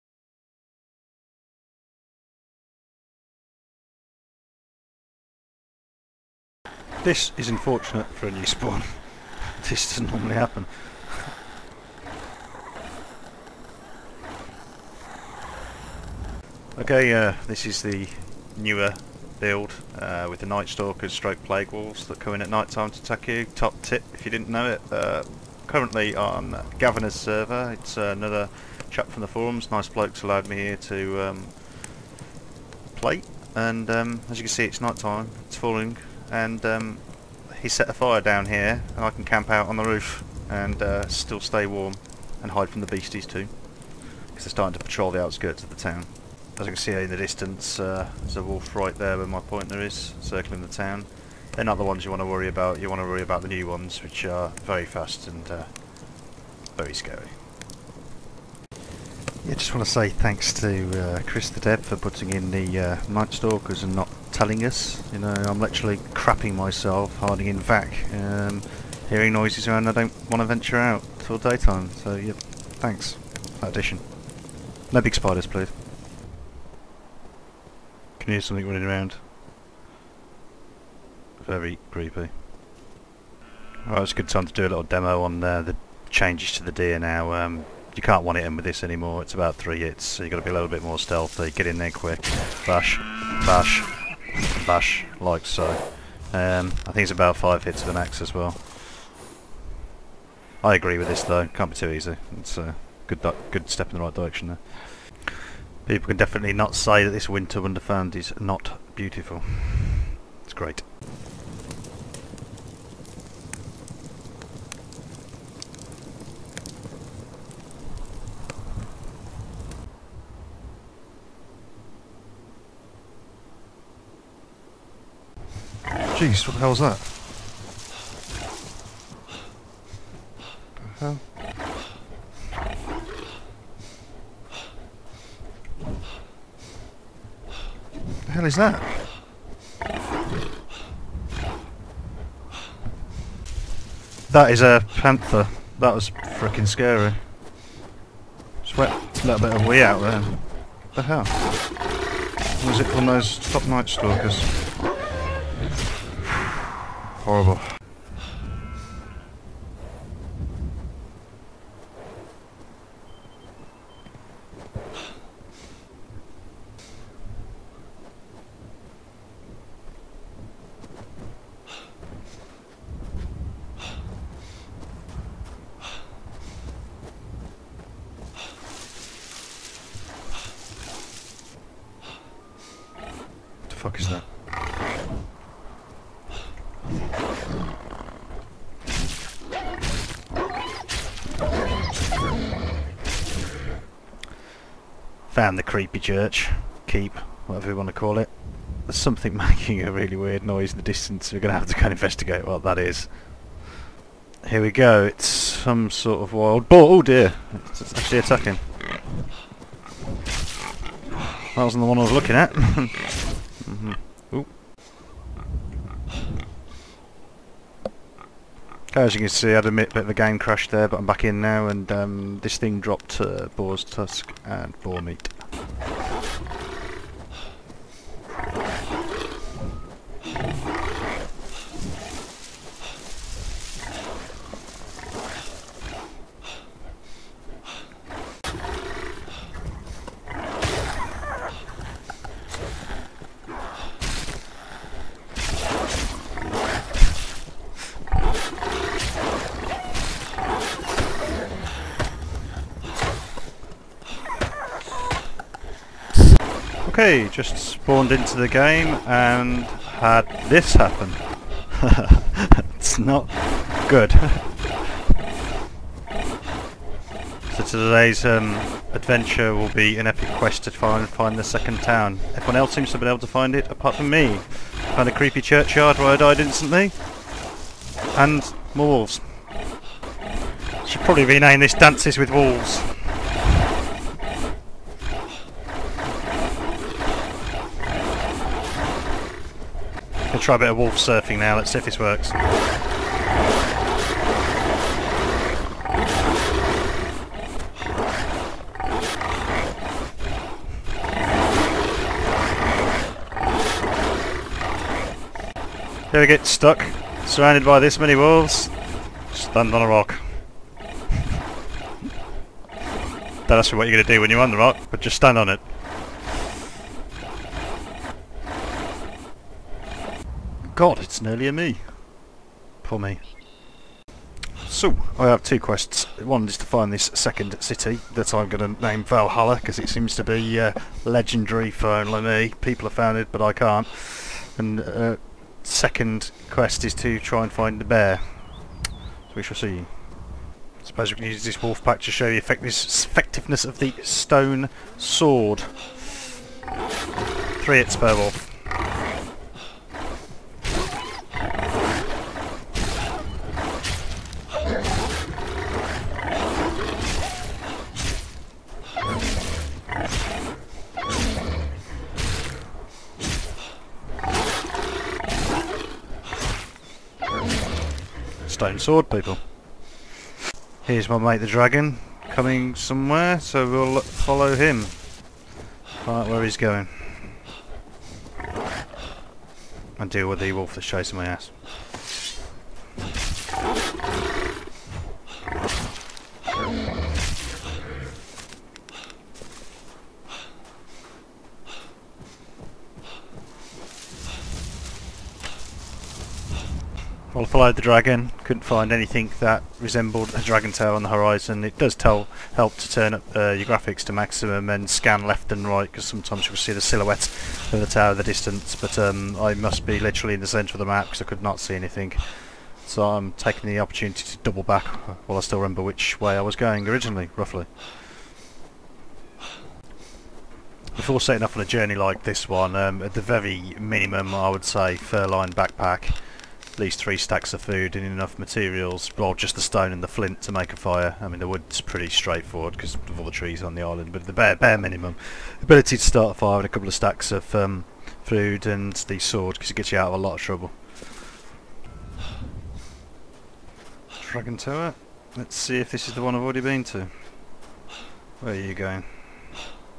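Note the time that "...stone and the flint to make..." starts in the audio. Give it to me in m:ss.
7:09.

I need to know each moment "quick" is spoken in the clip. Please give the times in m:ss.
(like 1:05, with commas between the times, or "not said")
1:31.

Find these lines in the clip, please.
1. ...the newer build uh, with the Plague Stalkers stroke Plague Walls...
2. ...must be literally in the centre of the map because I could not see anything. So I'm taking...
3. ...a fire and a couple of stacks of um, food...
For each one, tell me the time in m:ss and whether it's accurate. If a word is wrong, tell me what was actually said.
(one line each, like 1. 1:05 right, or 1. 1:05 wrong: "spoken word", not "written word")
1. 0:17 wrong: "Night", not "Plague"
2. 6:49 right
3. 7:16 right.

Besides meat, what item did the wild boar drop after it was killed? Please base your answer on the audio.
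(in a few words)
Boar's tusk.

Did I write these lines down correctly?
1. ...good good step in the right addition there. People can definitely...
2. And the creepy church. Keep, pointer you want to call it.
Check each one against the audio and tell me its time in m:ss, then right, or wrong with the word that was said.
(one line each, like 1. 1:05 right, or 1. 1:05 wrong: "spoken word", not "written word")
1. 1:43 wrong: "direction", not "addition"
2. 3:15 wrong: "whatever", not "pointer".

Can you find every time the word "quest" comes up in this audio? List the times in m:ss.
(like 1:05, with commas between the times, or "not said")
4:30, 5:25, 5:36.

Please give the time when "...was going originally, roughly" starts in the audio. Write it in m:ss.
6:56.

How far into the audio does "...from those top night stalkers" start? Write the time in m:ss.
2:32.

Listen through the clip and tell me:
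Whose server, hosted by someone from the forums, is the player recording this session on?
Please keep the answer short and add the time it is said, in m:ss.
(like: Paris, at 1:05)
Gavin, at 0:26.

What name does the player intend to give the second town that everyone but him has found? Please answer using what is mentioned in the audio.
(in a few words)
Valhalla.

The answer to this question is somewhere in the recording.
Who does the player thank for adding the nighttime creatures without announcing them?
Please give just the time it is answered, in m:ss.
1:01.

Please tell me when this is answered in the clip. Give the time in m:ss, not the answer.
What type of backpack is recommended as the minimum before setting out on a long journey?
7:04.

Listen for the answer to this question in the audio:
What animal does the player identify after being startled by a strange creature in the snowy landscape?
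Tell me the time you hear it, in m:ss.
2:24.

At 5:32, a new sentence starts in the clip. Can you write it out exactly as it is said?
People have found it, but I can't.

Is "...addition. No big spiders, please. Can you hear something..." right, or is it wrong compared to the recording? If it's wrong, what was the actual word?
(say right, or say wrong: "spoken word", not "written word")
right.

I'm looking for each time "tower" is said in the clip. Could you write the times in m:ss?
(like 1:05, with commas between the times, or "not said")
6:47, 7:24.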